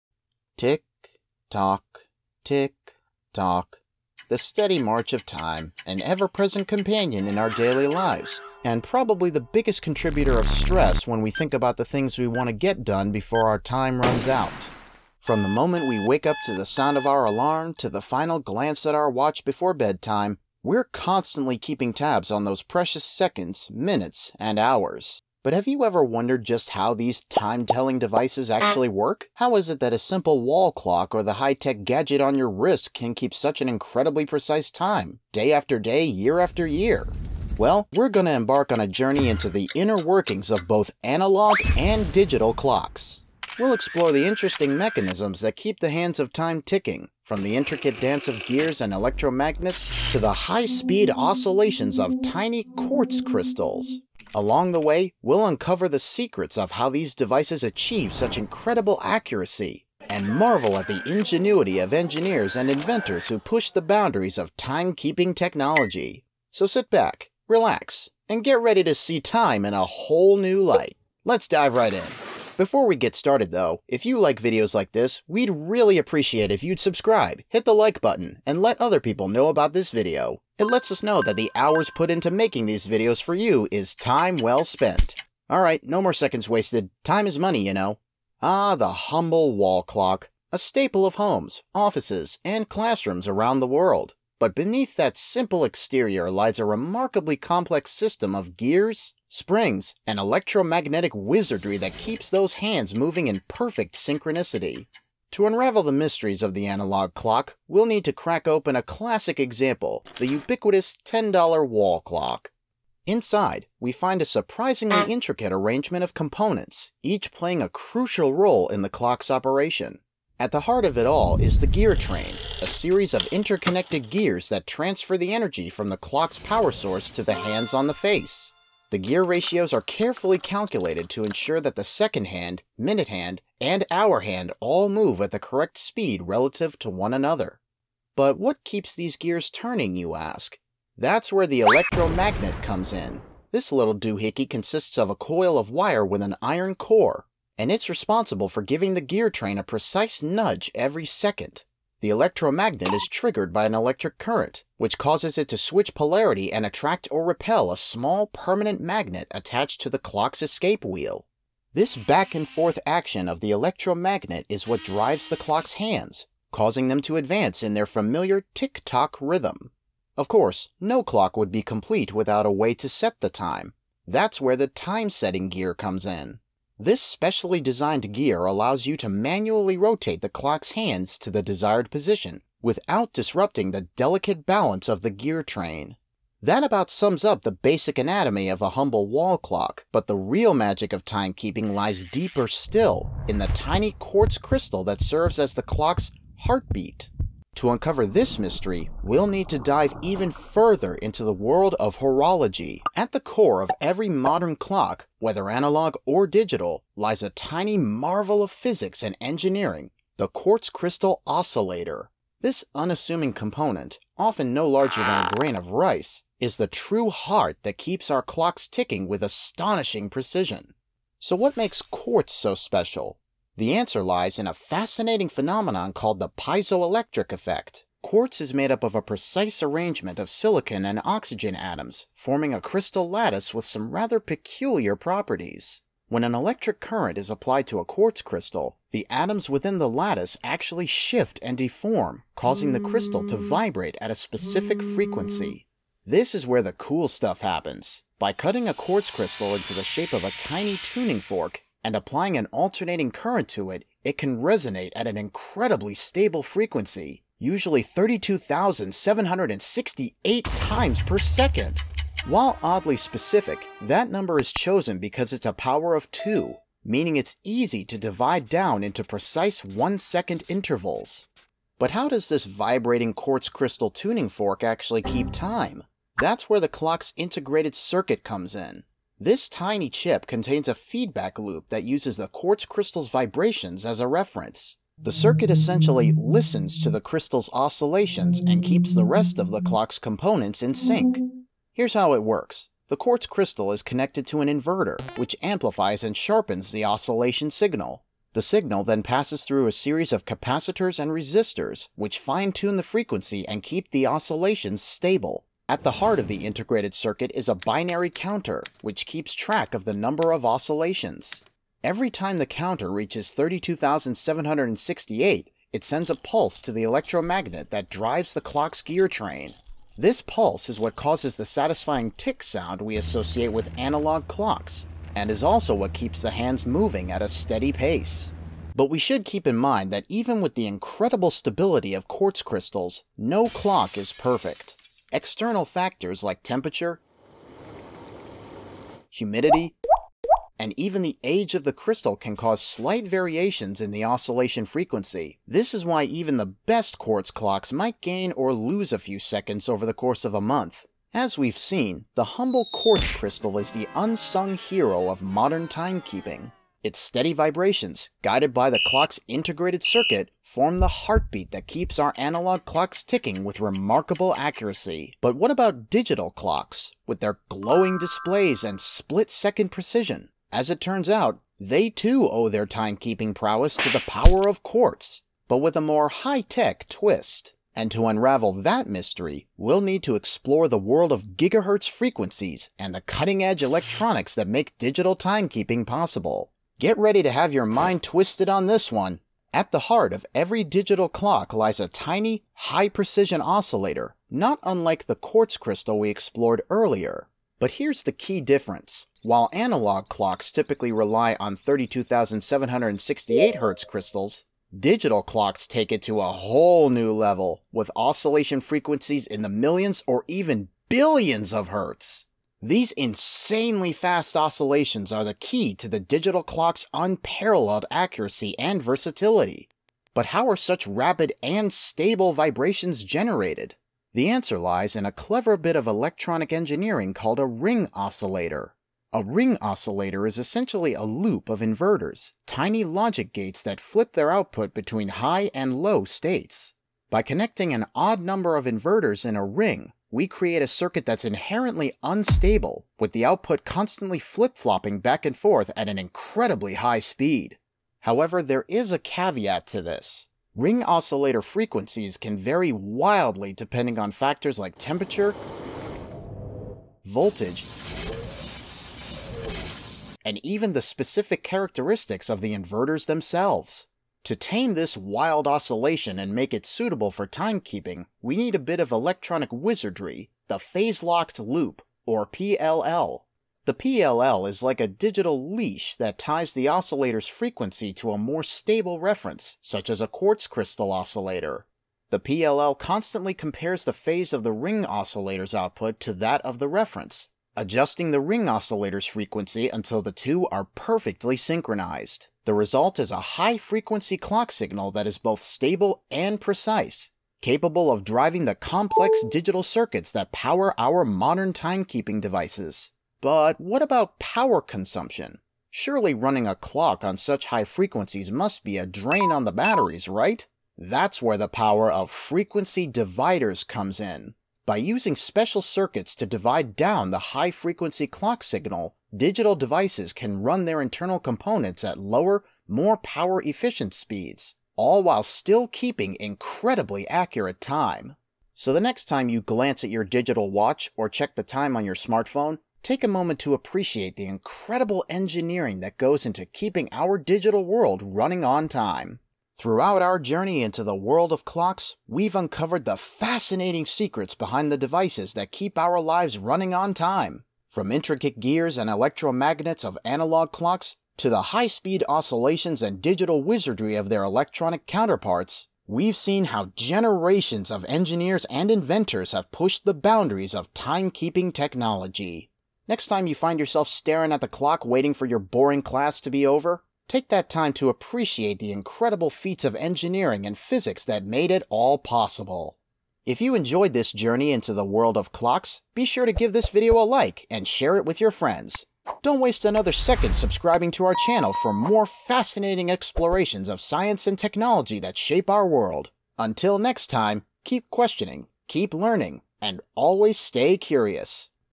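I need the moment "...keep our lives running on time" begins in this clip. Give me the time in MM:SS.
09:05.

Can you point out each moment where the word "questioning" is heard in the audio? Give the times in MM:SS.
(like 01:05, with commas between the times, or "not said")
09:47.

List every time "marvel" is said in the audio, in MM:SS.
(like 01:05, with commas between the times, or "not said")
01:00, 03:27.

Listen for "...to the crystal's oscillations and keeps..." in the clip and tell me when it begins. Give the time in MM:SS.
04:46.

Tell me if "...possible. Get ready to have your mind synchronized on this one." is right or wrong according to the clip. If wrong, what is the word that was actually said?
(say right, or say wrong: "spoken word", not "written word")
wrong: "twisted", not "synchronized".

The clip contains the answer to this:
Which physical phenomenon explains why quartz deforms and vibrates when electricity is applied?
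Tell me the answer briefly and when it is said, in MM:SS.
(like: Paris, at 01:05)
piezoelectric effect, at 03:46.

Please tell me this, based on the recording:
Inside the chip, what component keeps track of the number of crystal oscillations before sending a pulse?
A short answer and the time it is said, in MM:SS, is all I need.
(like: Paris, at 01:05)
binary counter, at 05:07.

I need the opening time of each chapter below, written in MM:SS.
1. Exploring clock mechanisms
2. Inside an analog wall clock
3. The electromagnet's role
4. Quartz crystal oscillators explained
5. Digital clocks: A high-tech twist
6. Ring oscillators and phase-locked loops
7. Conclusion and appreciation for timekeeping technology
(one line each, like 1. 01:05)
1. 00:29
2. 01:11
3. 02:18
4. 03:23
5. 05:53
6. 07:00
7. 08:49.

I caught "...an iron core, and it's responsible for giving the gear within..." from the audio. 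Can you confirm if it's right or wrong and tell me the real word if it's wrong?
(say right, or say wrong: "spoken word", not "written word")
wrong: "train", not "within".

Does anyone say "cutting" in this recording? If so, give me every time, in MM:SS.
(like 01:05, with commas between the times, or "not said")
04:08, 06:23.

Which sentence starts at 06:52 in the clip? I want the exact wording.
These insanely fast oscillations are the key to the digital clock's unparalleled accuracy and versatility.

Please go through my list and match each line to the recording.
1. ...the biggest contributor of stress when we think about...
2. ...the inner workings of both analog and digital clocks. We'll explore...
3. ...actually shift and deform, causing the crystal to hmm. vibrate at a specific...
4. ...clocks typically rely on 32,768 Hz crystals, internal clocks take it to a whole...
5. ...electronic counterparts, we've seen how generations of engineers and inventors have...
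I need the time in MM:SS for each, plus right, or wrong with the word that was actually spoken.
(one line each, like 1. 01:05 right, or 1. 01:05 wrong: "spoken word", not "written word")
1. 00:09 right
2. 00:39 right
3. 04:00 right
4. 06:40 wrong: "digital", not "internal"
5. 09:14 right.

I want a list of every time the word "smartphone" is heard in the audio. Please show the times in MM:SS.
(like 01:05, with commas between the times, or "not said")
08:51.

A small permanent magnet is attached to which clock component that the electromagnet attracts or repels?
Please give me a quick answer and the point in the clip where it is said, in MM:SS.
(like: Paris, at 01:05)
escape wheel, at 02:40.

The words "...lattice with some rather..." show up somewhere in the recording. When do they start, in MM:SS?
03:53.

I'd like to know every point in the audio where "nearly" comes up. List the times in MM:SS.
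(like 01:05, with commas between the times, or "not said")
not said.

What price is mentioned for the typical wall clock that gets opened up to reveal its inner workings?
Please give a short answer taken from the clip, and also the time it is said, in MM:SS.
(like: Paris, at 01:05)
$10, at 01:51.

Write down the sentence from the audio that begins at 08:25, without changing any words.
Surely running a clock on such high frequencies must be a drain on the batteries, right?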